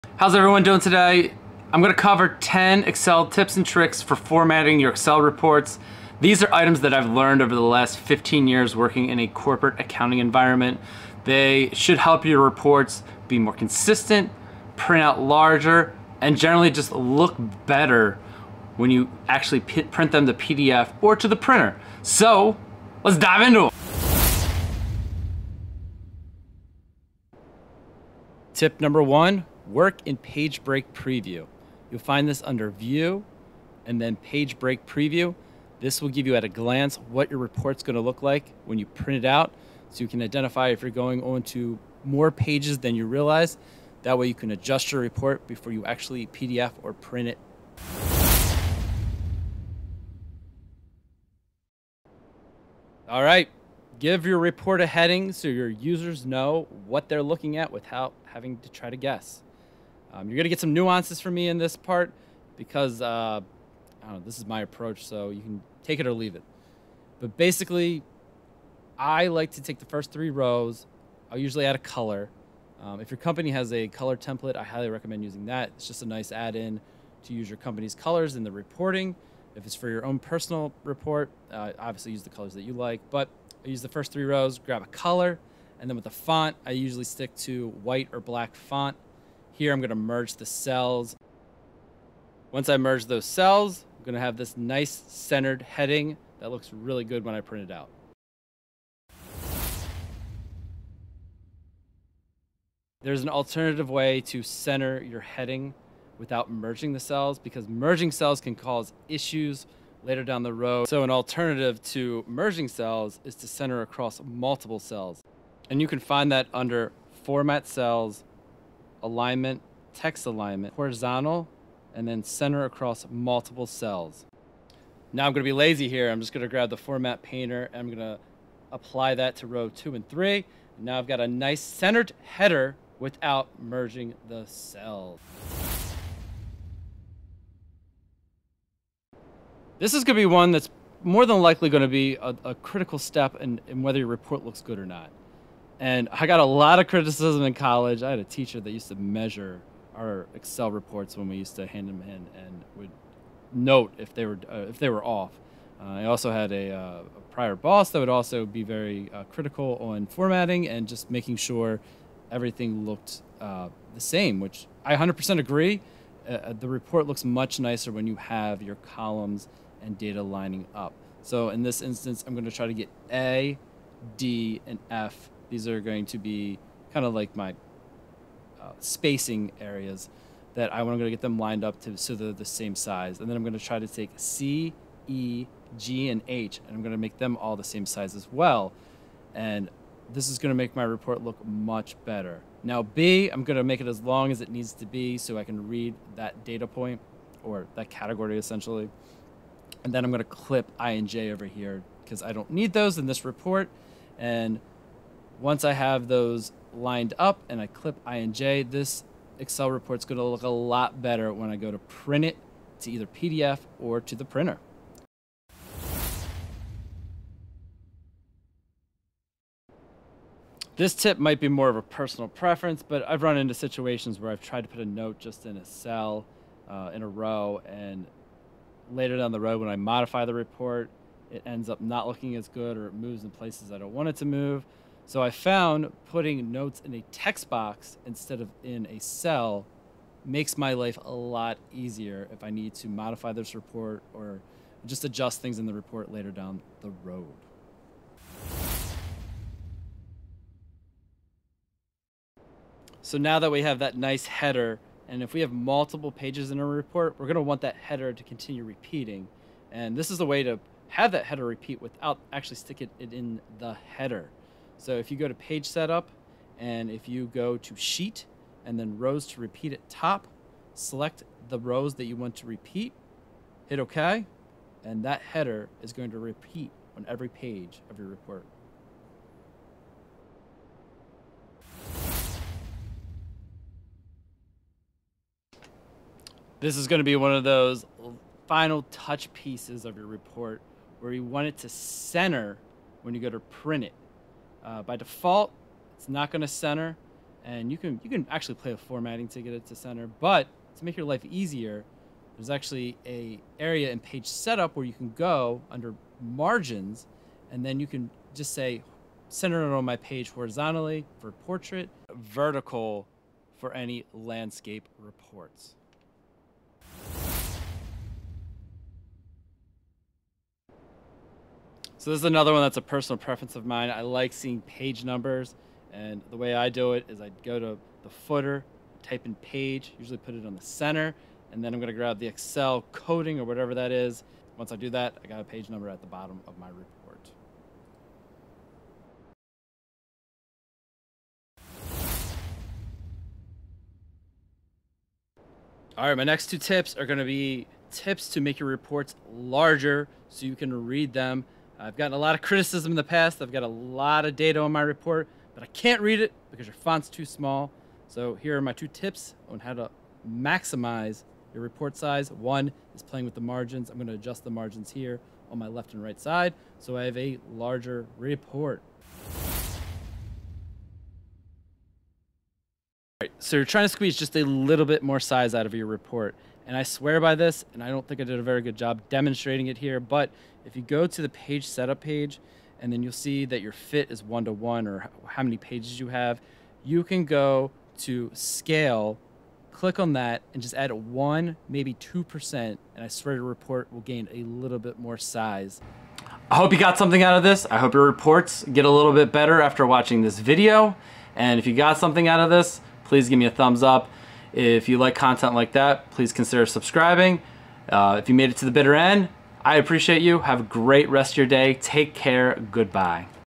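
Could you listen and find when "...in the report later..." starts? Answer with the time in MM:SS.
04:05.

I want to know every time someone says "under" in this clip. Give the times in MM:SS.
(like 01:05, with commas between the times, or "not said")
00:32, 01:56, 05:05.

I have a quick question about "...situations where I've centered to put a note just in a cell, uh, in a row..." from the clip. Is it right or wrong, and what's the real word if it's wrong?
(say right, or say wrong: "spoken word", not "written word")
wrong: "tried", not "centered".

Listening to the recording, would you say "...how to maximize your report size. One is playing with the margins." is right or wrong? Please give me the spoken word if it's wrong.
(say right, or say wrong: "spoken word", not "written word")
right.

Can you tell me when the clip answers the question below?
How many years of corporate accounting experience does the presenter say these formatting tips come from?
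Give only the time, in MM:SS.
00:07.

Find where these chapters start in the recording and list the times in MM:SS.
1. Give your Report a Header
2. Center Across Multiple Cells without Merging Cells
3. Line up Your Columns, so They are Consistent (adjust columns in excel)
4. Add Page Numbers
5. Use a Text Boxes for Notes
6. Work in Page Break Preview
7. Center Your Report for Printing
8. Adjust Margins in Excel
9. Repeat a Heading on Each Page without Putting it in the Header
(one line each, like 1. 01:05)
1. 00:49
2. 01:40
3. 02:16
4. 05:18
5. 03:37
6. 00:25
7. 04:44
8. 05:45
9. 04:10.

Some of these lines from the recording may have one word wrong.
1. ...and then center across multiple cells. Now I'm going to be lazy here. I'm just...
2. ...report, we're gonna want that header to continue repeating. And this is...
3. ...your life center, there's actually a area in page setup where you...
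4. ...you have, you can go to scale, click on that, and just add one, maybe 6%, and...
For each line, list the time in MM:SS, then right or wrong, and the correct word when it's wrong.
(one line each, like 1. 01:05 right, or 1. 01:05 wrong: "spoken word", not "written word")
1. 02:01 right
2. 04:16 right
3. 05:00 wrong: "easier", not "center"
4. 06:25 wrong: "2", not "6".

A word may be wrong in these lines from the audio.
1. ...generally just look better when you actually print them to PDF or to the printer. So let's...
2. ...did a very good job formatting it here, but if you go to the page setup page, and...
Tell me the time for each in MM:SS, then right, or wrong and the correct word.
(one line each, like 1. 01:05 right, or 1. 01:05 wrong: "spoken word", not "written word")
1. 00:16 right
2. 06:18 wrong: "demonstrating", not "formatting".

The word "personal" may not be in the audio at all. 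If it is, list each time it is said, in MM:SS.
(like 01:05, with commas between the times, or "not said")
01:20, 03:41, 05:22.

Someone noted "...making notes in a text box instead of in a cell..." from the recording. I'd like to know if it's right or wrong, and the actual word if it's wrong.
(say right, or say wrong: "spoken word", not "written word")
wrong: "putting", not "making".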